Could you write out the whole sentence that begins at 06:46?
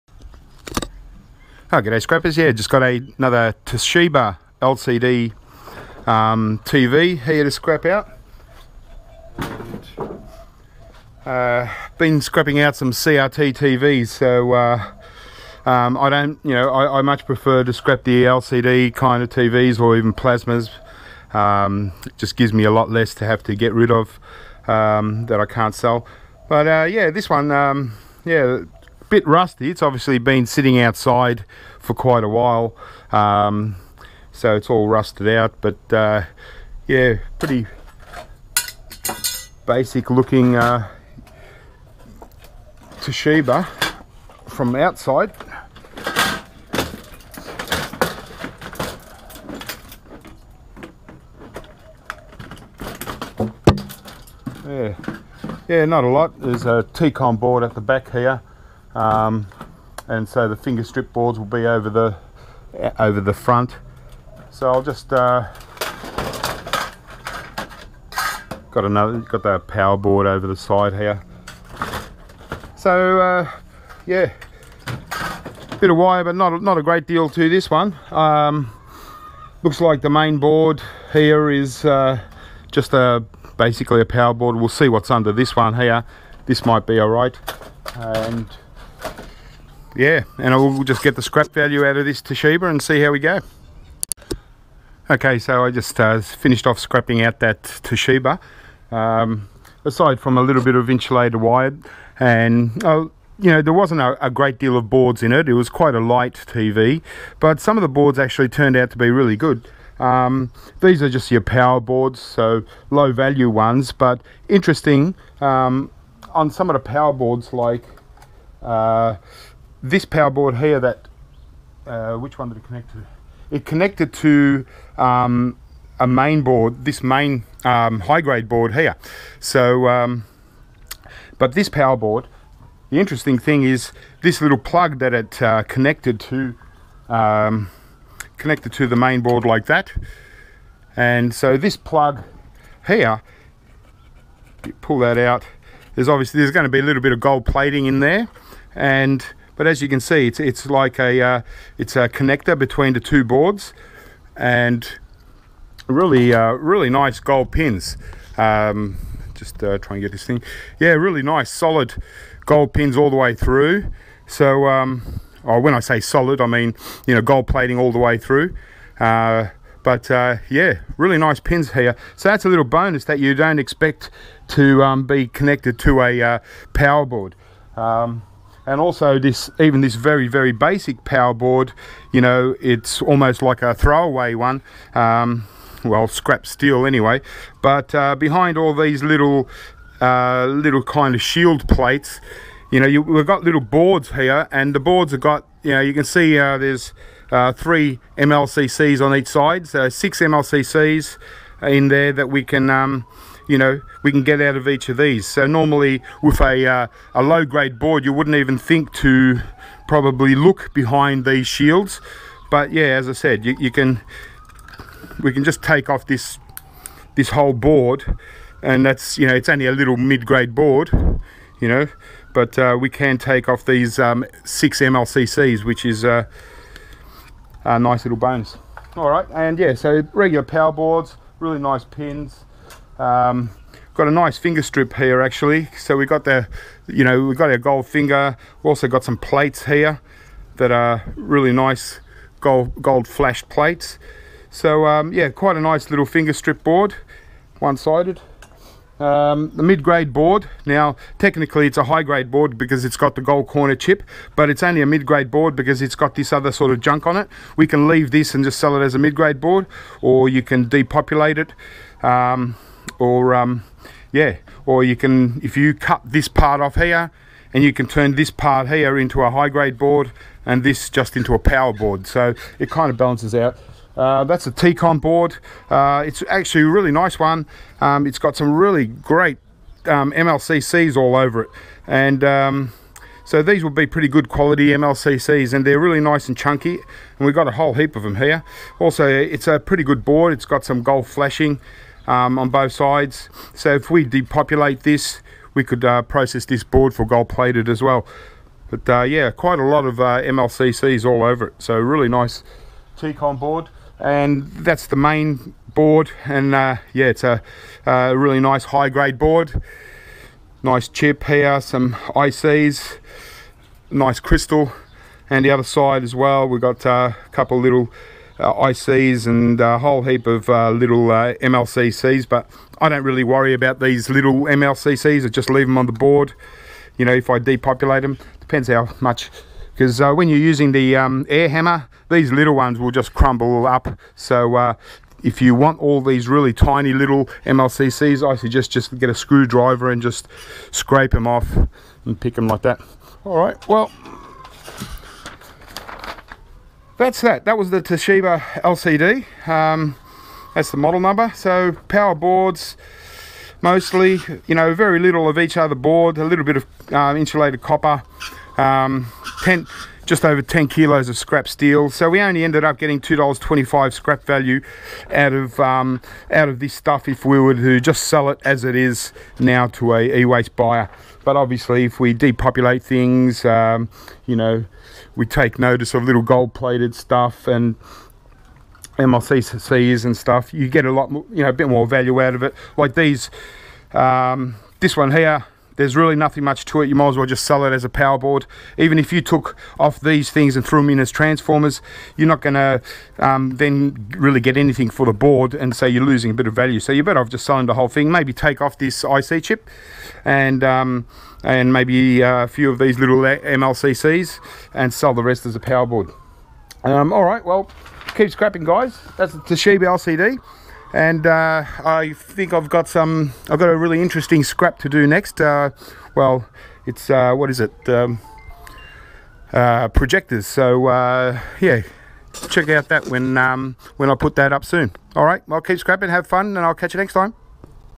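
Um, all right, well, keep scrapping, guys.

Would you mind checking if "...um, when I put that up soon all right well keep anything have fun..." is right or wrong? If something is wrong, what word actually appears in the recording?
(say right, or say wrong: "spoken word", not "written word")
wrong: "scrapping", not "anything".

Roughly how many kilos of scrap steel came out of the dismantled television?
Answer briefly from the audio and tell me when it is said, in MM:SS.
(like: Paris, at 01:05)
just over 10, at 06:00.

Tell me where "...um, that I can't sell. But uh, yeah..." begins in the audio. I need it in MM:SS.
00:24.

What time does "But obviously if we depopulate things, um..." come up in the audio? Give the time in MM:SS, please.
06:11.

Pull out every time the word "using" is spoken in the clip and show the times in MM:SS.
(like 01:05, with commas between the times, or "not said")
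05:30.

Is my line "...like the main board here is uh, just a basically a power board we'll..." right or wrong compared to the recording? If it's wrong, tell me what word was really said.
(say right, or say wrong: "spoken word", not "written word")
right.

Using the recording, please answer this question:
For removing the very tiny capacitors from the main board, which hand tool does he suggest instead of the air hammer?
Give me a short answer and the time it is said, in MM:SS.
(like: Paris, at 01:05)
screwdriver, at 05:39.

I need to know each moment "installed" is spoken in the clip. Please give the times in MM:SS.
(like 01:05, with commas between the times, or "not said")
not said.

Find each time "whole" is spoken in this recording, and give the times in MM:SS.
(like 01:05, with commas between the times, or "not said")
03:37, 04:47, 05:19, 06:37.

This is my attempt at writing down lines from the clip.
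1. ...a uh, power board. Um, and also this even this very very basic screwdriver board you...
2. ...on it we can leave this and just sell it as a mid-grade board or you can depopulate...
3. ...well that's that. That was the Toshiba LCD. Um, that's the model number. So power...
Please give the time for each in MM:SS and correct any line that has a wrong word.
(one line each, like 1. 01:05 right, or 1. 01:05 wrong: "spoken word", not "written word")
1. 02:56 wrong: "power", not "screwdriver"
2. 04:17 right
3. 05:43 right.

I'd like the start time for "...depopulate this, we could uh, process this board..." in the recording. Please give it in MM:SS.
04:54.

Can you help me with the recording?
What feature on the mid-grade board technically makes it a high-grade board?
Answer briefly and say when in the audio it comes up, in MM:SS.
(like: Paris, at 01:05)
gold corner chip, at 04:13.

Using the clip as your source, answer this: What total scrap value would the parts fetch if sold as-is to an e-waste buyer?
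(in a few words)
$2.25.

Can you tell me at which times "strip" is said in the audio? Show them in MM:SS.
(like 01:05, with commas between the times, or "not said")
01:00, 03:54, 04:06.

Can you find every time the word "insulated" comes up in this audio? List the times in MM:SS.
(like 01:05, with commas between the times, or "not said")
01:40, 05:57.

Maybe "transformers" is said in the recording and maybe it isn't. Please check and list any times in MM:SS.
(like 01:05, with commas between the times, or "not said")
06:31.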